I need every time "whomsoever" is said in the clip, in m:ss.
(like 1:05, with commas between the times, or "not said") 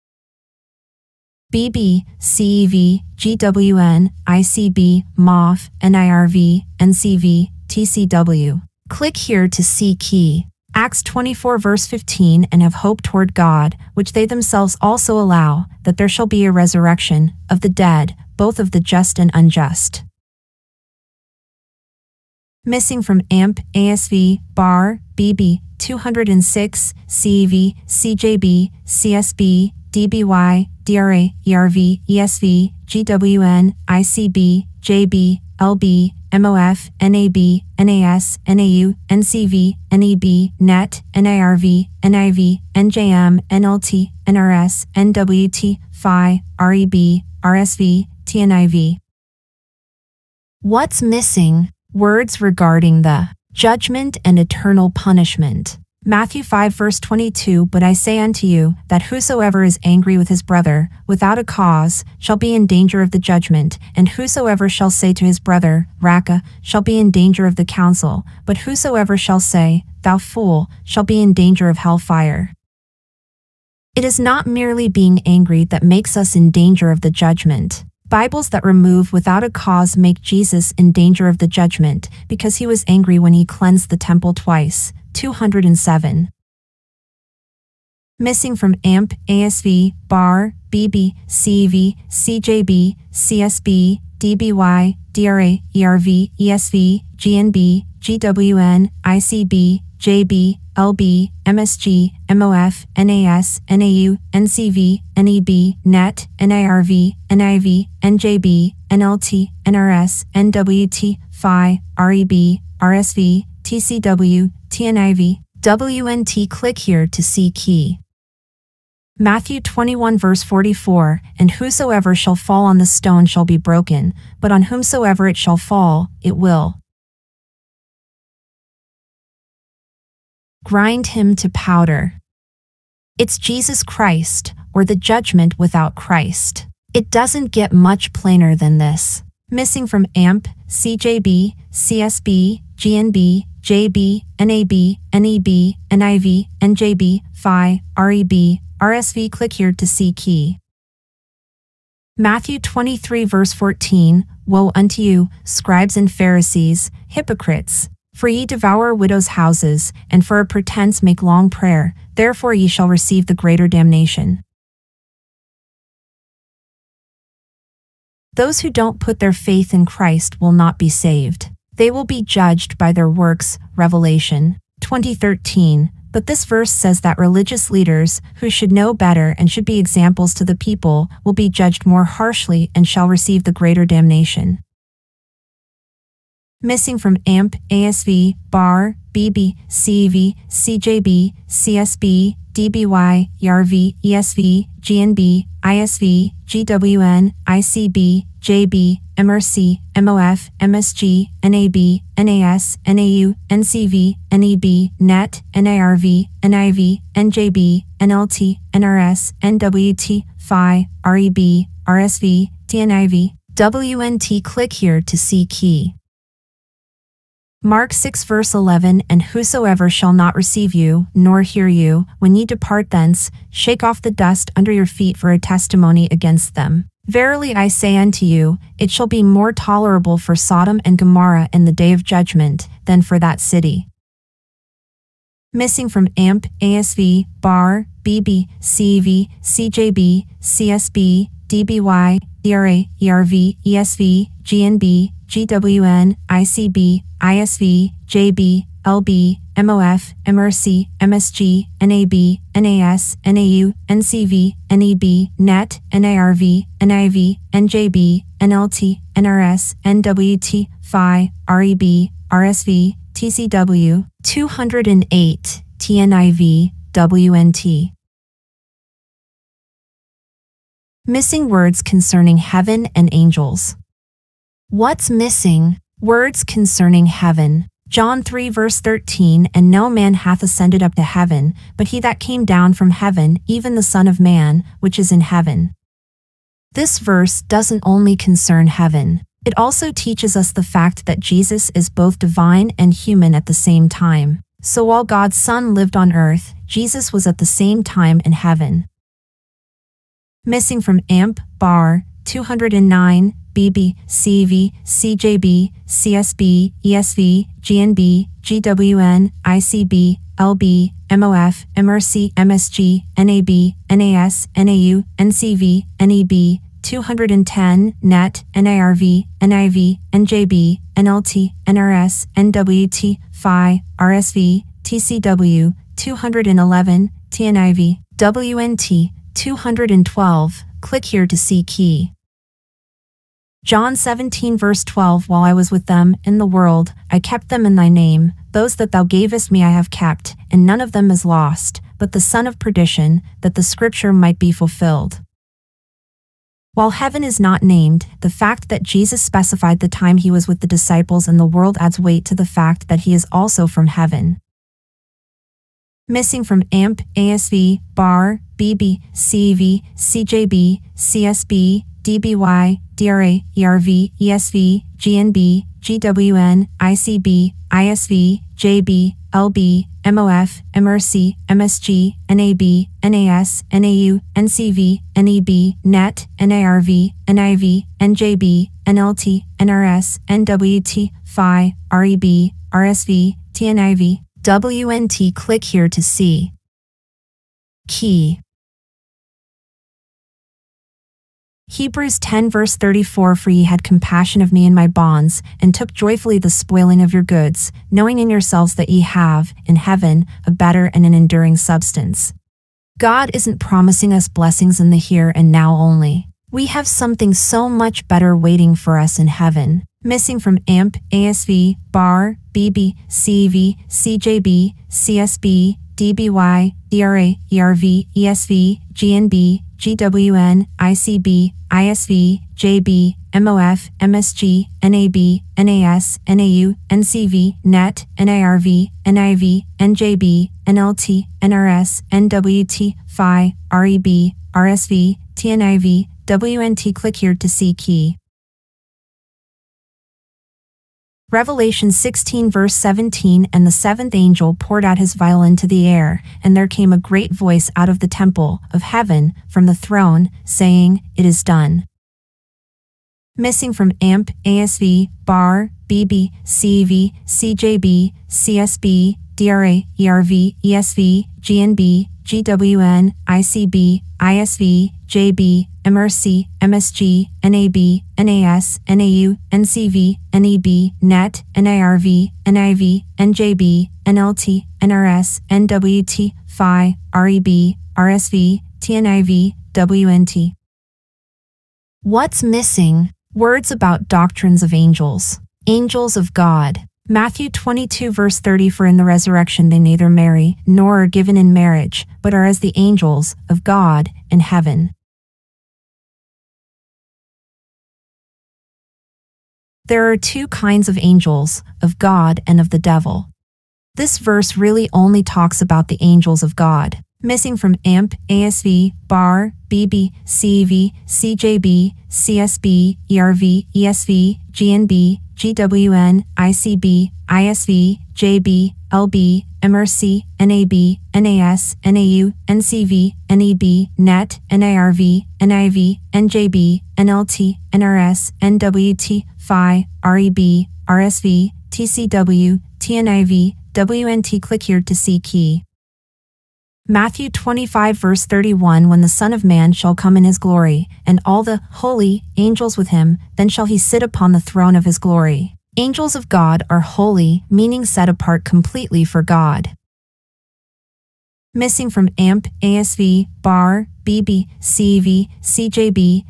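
2:04.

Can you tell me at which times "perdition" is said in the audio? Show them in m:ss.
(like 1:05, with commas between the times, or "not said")
5:42.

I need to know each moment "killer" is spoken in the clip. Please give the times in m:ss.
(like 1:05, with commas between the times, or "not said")
not said.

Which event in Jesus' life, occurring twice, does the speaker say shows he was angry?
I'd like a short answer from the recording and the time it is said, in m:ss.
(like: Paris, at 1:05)
Cleansed the temple, at 1:23.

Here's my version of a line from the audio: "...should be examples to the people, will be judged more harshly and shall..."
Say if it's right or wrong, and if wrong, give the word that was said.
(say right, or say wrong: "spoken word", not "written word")
right.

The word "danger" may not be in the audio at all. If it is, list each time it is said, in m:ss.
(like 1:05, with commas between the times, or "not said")
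1:02, 1:07, 1:11, 1:16, 1:20.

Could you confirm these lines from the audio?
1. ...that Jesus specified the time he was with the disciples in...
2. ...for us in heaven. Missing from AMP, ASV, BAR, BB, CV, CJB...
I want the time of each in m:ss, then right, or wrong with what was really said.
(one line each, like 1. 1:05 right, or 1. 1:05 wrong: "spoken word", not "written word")
1. 5:48 right
2. 6:48 right.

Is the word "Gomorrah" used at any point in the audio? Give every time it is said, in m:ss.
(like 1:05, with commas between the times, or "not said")
3:50.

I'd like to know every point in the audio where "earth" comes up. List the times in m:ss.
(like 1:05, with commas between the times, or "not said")
4:56.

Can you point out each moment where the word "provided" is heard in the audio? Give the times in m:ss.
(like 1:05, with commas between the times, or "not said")
not said.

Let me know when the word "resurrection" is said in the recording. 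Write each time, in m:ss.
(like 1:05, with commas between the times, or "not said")
0:16, 8:09.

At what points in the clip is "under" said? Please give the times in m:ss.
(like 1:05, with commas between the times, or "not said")
3:44.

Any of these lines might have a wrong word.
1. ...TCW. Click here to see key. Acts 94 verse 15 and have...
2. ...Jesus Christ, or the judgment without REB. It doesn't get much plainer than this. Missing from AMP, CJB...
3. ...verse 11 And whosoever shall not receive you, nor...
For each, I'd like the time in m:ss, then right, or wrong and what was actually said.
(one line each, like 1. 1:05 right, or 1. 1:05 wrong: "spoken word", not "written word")
1. 0:07 wrong: "24", not "94"
2. 2:13 wrong: "Christ", not "REB"
3. 3:38 right.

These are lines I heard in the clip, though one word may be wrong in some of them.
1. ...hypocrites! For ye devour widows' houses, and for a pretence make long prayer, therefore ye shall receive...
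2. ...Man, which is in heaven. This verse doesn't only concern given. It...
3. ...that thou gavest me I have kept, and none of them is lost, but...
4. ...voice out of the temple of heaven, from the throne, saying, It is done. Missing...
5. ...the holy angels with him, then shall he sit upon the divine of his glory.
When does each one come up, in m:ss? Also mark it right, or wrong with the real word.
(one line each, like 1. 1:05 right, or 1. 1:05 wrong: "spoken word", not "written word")
1. 2:37 right
2. 4:44 wrong: "heaven", not "given"
3. 5:38 right
4. 7:27 right
5. 9:01 wrong: "throne", not "divine".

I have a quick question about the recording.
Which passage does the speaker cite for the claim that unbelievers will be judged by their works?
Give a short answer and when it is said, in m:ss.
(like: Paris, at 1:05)
Revelation 20:13, at 2:53.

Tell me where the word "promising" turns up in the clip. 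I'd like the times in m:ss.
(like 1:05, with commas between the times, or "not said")
6:43.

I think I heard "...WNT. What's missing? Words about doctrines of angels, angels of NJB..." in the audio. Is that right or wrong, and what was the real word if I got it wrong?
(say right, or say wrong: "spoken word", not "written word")
wrong: "God", not "NJB".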